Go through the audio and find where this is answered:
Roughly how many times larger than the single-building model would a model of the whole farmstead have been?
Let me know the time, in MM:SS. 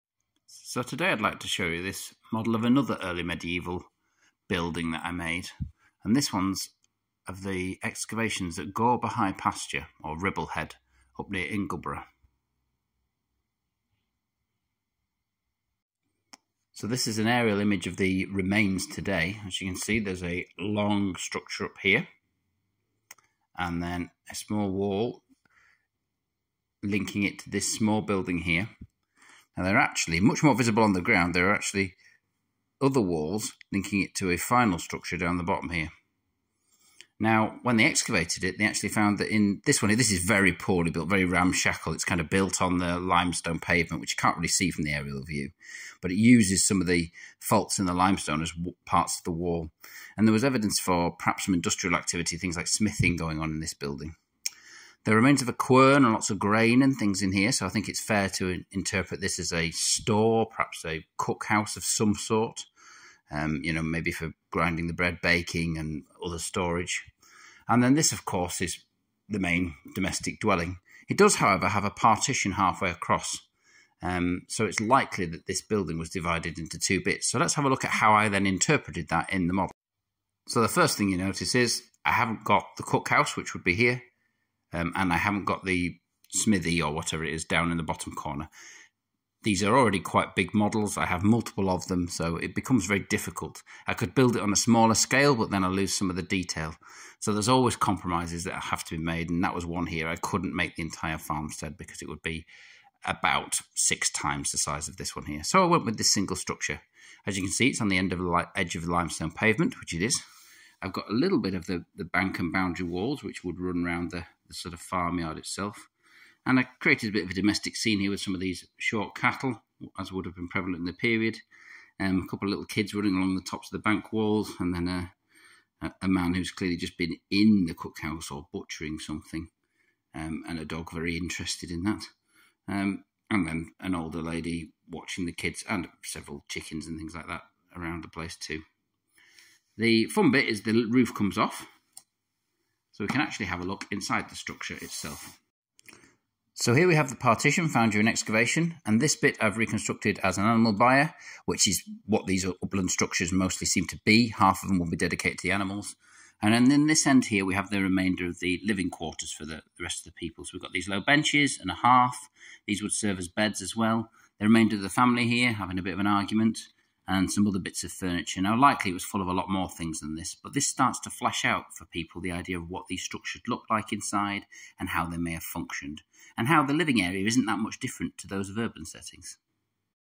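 01:43.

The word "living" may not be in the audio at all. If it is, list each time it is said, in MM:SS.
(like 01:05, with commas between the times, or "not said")
02:38, 02:56.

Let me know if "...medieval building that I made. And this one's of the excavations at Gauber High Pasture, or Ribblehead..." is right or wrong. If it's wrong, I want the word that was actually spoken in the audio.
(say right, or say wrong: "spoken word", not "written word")
right.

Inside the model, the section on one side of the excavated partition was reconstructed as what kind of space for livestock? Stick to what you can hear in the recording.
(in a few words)
An animal byre.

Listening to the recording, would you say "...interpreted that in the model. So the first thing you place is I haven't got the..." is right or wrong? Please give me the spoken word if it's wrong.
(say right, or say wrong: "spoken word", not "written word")
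wrong: "notice", not "place".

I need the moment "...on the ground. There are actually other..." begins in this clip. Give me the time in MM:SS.
00:30.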